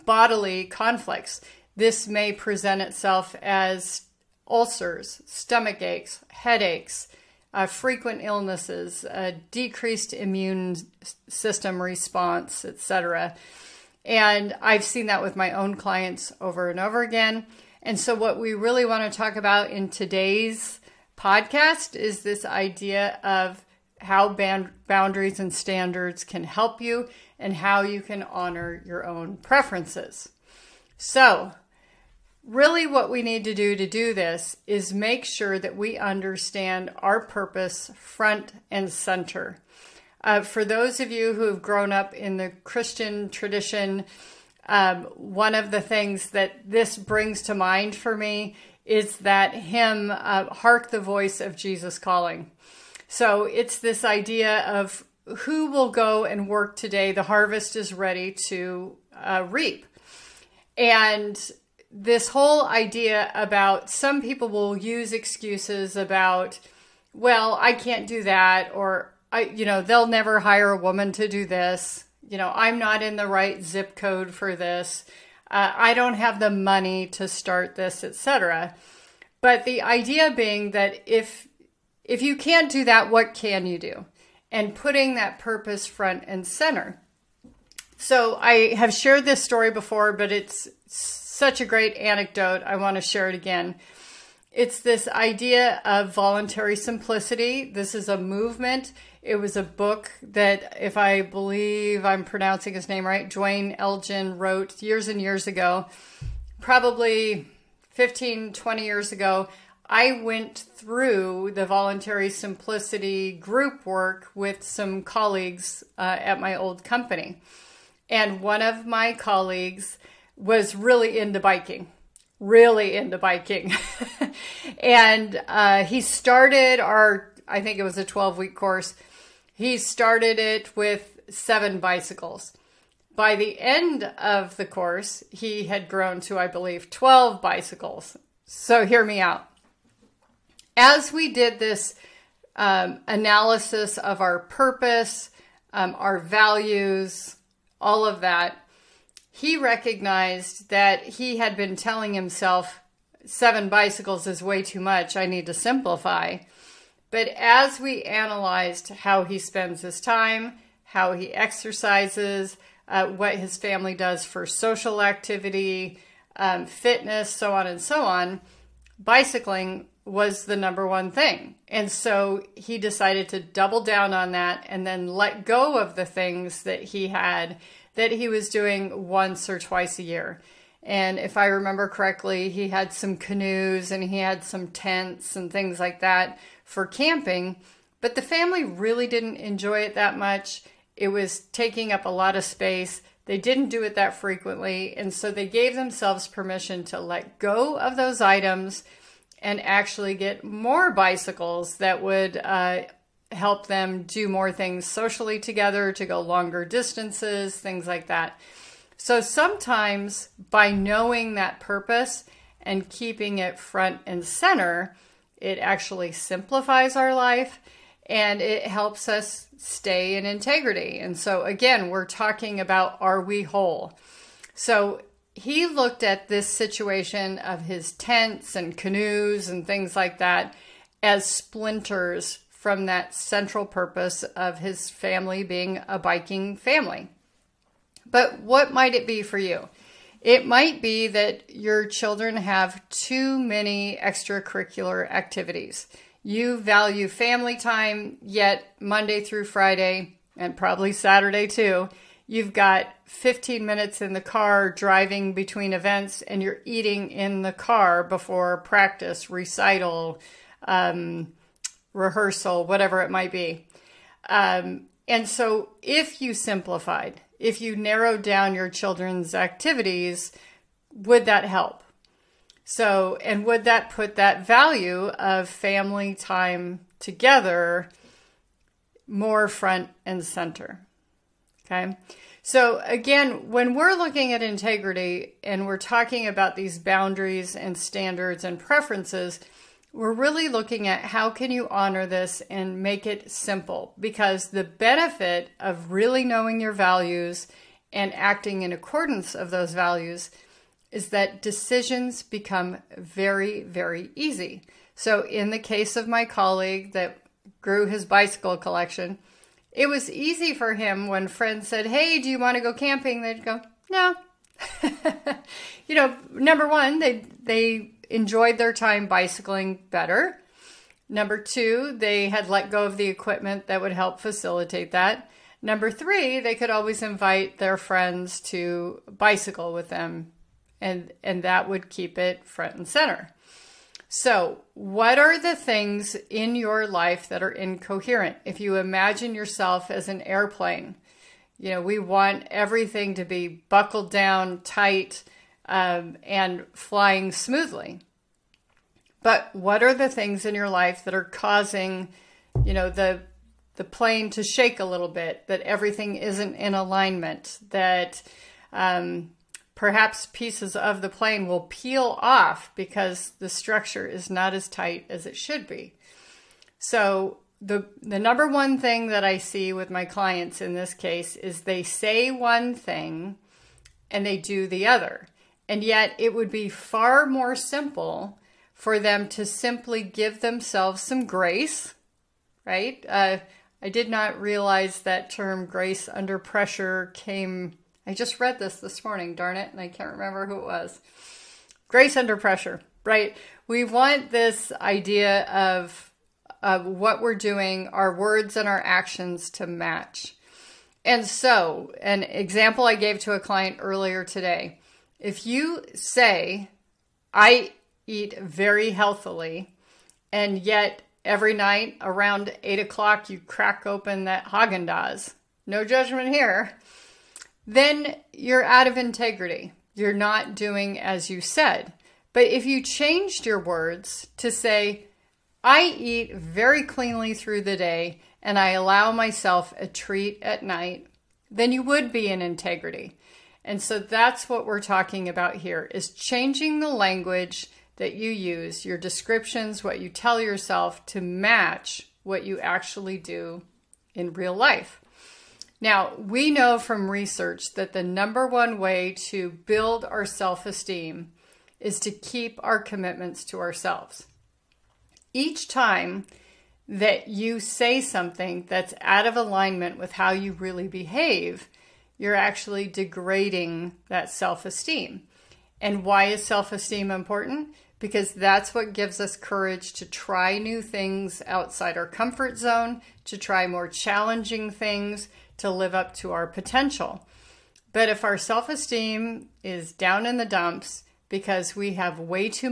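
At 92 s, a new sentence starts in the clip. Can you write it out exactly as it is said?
I want to share it again.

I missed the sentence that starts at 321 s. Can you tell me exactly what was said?
Number two, they had let go of the equipment that would help facilitate that.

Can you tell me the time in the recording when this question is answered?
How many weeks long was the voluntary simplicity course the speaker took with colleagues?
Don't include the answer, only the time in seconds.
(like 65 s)
128 s.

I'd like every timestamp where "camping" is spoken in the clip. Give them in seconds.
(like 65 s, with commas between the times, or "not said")
186 s, 312 s.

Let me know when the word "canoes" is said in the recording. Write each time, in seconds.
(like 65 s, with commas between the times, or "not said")
183 s, 228 s.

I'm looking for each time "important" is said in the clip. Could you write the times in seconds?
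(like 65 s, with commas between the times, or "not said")
467 s.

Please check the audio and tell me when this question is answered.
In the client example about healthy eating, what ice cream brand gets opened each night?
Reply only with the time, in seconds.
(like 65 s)
414 s.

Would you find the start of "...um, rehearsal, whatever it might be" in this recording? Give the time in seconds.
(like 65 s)
260 s.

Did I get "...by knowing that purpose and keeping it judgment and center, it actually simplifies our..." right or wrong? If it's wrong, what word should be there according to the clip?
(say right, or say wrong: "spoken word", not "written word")
wrong: "front", not "judgment".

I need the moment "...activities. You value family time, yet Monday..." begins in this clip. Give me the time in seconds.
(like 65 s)
245 s.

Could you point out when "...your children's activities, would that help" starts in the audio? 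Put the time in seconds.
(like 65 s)
268 s.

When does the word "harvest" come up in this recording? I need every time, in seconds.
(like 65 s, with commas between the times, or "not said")
57 s.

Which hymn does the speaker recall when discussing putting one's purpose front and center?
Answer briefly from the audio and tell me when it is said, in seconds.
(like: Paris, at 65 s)
Hark the Voice of Jesus Calling, at 50 s.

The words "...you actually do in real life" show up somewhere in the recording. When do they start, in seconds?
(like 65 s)
442 s.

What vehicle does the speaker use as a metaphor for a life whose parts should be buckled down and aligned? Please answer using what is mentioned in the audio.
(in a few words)
airplane.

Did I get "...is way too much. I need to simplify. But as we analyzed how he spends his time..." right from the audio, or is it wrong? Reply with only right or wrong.
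right.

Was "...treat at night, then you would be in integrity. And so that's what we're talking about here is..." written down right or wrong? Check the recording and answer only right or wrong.
right.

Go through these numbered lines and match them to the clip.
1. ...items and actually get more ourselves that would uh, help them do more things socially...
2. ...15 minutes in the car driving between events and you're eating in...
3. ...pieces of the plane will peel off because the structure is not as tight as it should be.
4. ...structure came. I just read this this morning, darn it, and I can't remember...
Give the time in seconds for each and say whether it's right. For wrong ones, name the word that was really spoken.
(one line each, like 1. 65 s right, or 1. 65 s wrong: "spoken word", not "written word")
1. 198 s wrong: "bicycles", not "ourselves"
2. 253 s right
3. 360 s right
4. 386 s wrong: "pressure", not "structure".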